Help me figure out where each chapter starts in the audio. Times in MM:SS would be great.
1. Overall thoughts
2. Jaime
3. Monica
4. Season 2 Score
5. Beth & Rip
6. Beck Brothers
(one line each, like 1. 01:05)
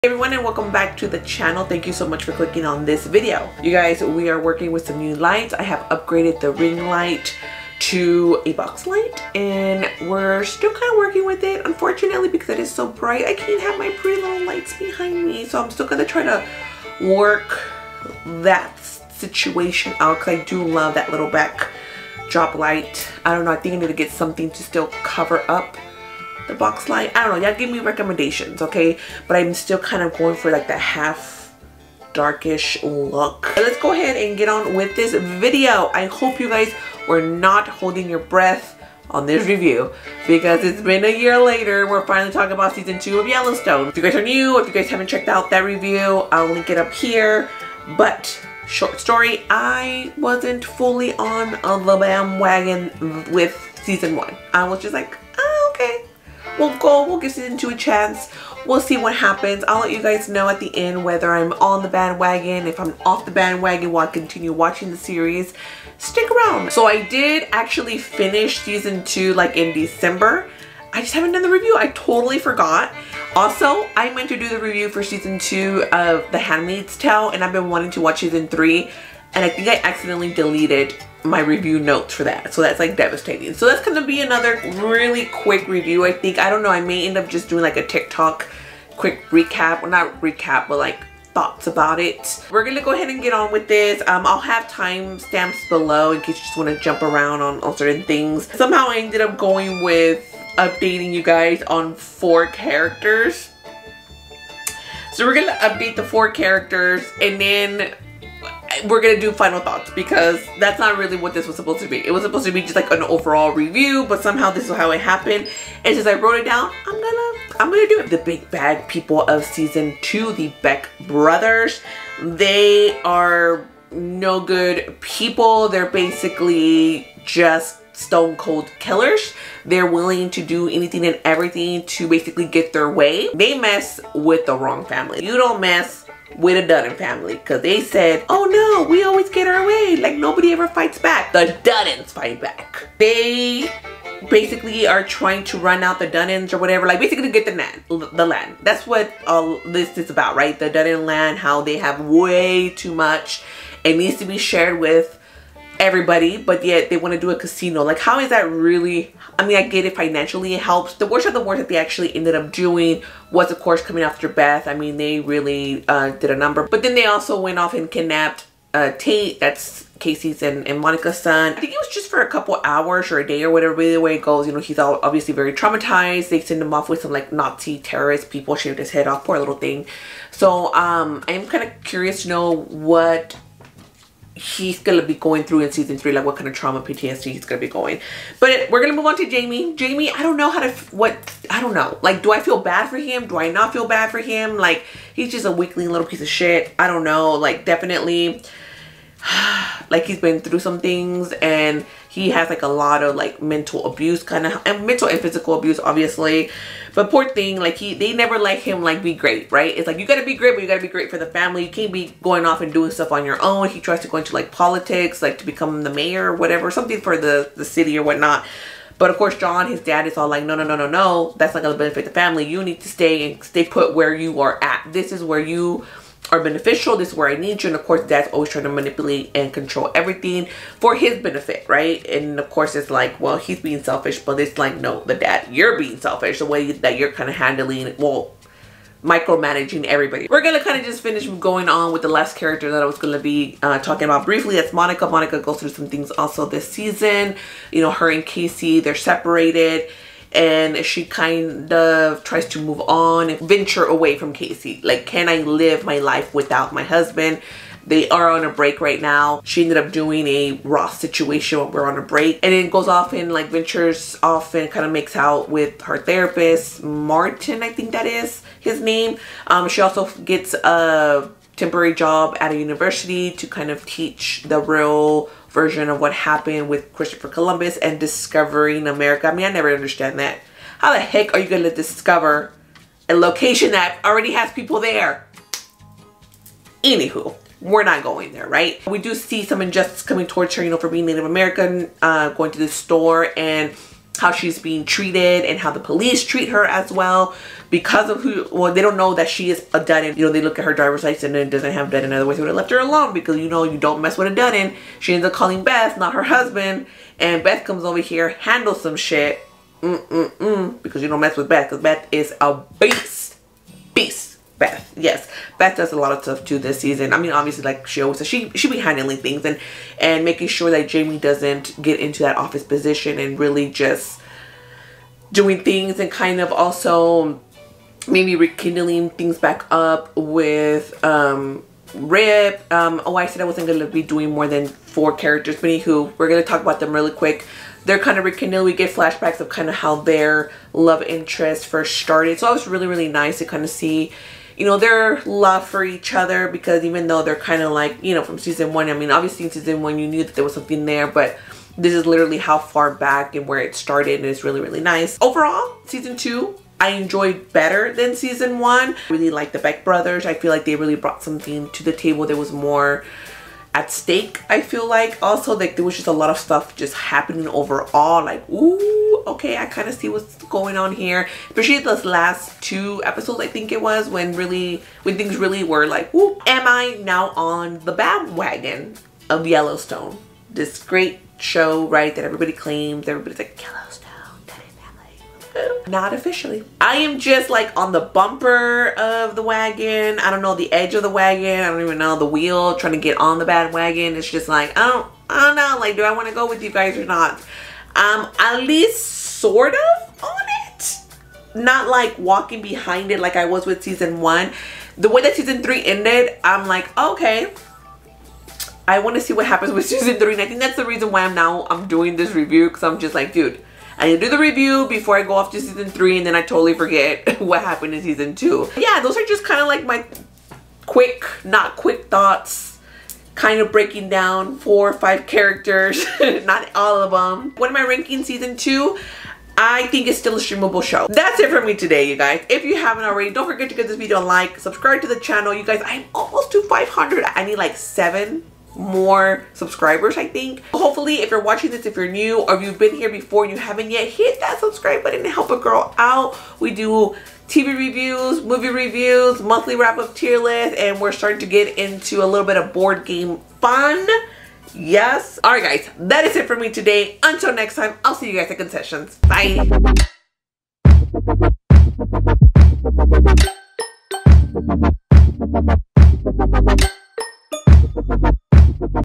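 1. 05:55
2. 03:08
3. 04:00
4. 07:07
5. 05:15
6. 01:58.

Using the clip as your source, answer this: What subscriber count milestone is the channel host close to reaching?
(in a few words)
500.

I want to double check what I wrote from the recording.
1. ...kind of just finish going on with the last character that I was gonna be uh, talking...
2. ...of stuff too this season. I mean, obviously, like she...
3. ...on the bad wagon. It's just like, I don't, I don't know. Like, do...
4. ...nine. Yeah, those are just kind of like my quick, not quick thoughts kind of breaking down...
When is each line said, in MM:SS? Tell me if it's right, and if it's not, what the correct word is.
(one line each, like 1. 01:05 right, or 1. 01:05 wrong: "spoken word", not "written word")
1. 04:00 right
2. 05:16 right
3. 06:33 right
4. 06:58 wrong: "two", not "nine".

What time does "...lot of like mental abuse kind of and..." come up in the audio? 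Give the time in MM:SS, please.
03:22.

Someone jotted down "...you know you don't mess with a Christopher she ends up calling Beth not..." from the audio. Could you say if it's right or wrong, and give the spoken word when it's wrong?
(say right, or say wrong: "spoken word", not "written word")
wrong: "Dutton", not "Christopher".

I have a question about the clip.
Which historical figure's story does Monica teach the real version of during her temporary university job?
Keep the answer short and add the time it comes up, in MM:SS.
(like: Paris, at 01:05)
Christopher Columbus, at 04:36.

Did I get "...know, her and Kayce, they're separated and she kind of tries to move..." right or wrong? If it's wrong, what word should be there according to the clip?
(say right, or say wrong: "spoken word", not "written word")
right.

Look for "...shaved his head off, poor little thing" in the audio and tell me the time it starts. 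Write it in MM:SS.
02:58.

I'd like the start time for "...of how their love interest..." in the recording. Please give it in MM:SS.
05:39.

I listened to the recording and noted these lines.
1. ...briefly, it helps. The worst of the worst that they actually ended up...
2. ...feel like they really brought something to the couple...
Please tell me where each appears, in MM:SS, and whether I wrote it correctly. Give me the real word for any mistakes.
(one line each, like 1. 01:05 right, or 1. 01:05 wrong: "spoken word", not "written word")
1. 02:39 wrong: "financially", not "briefly"
2. 06:00 wrong: "table", not "couple".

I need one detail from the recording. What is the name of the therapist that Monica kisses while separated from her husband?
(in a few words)
Martin.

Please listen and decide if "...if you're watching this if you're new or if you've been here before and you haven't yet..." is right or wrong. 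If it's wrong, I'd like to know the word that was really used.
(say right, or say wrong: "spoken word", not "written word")
right.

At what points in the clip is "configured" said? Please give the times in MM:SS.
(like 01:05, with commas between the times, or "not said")
not said.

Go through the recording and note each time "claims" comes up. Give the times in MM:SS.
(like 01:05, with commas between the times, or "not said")
06:22.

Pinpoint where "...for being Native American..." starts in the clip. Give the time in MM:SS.
04:50.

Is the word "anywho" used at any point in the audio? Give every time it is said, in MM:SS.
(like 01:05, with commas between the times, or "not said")
04:46, 05:35.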